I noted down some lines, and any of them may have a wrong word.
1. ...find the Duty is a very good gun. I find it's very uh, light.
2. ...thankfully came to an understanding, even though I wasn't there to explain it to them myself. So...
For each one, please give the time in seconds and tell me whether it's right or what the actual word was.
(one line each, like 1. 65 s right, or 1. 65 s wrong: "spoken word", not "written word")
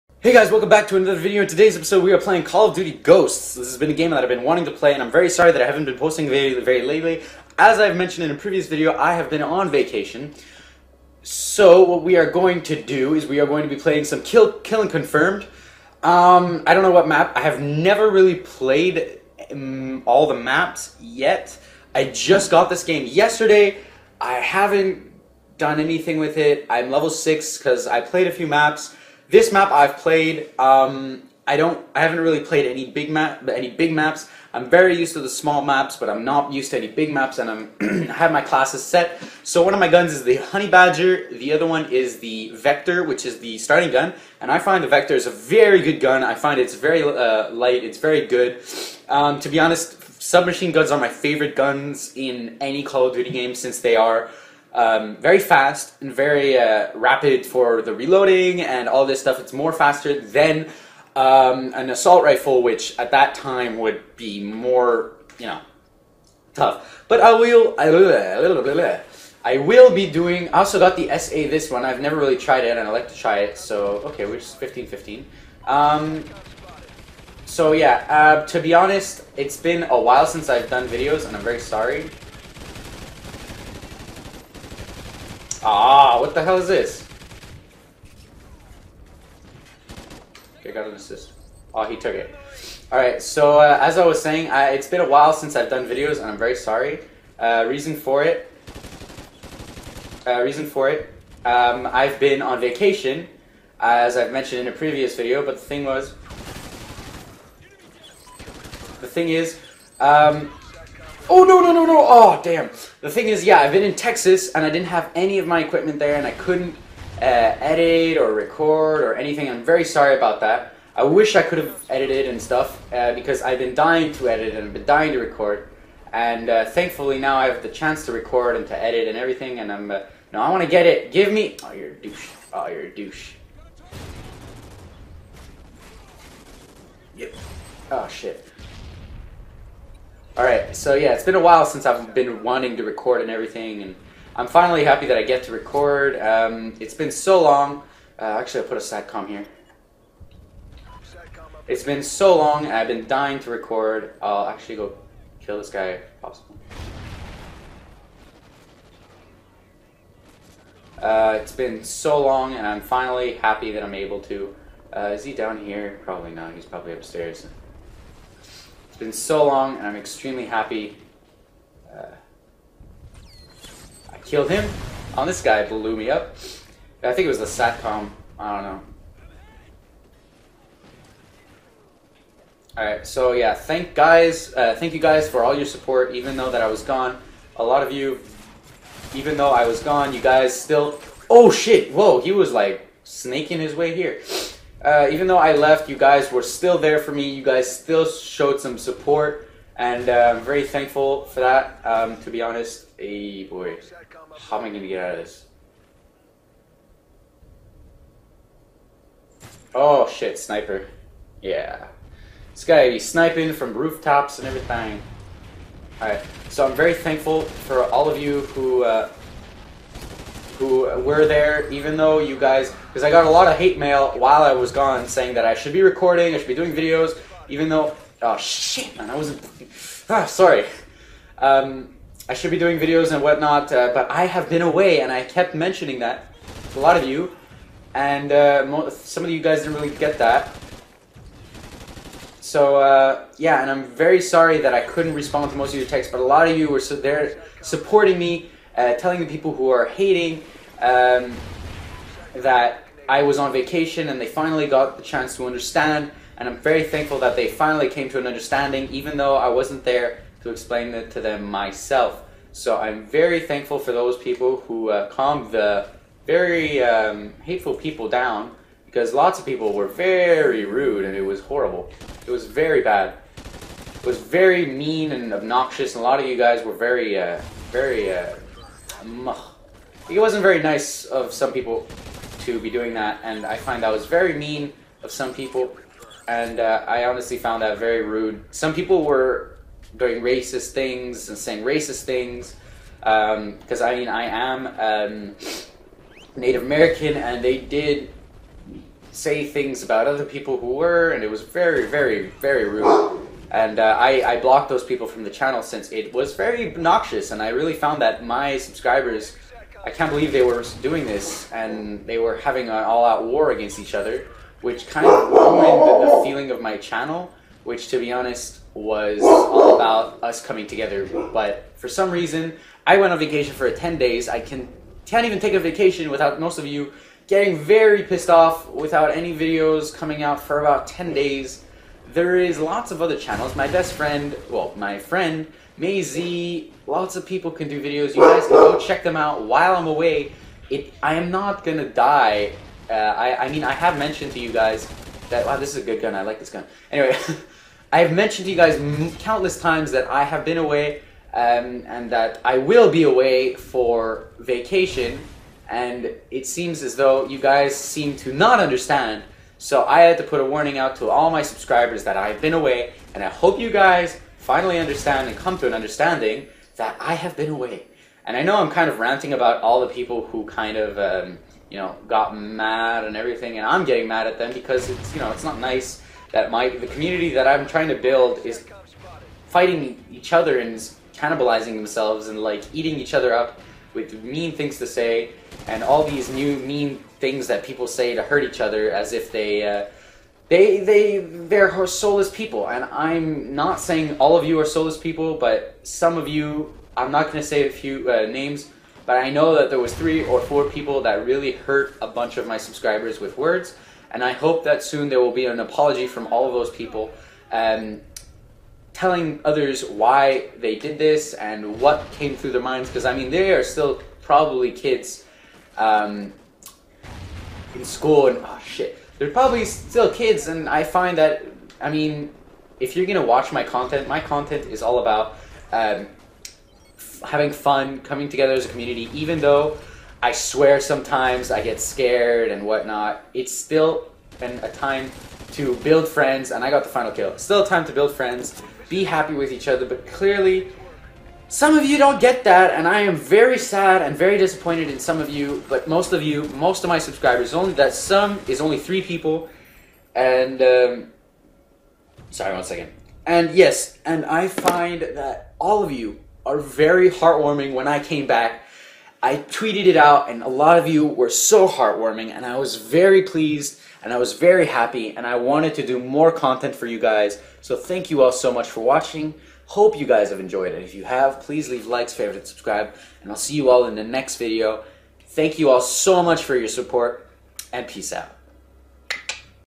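1. 44 s wrong: "Vector", not "Duty"
2. 257 s wrong: "finally", not "thankfully".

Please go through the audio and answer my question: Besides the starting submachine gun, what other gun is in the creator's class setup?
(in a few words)
Honey Badger.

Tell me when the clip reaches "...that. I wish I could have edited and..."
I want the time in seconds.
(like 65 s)
120 s.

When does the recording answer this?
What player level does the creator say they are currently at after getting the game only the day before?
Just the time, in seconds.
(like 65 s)
26 s.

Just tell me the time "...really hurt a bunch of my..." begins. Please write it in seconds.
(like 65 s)
401 s.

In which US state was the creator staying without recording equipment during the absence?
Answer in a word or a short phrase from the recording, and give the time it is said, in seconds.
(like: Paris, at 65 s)
Texas, at 113 s.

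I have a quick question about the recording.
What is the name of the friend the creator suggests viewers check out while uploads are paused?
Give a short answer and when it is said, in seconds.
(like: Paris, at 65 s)
Maisie, at 335 s.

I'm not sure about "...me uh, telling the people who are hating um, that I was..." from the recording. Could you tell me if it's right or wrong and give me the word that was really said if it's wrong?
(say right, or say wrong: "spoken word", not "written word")
right.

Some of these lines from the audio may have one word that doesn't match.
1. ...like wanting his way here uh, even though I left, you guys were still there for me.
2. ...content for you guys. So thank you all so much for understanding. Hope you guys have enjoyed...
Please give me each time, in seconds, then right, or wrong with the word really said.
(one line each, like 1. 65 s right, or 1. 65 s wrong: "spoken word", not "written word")
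1. 192 s wrong: "snaking", not "wanting"
2. 466 s wrong: "watching", not "understanding".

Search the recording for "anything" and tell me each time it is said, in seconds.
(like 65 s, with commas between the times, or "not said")
25 s, 119 s.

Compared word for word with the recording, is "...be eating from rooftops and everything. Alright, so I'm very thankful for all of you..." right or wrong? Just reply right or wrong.
wrong.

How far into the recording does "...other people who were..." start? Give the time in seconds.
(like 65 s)
300 s.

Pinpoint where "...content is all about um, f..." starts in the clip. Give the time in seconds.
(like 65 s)
424 s.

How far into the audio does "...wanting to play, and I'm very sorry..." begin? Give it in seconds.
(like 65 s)
4 s.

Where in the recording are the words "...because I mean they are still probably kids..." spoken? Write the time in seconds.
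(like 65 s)
412 s.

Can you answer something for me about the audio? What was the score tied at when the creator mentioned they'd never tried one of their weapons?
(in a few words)
15-15.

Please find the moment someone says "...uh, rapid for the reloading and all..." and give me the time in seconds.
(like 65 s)
56 s.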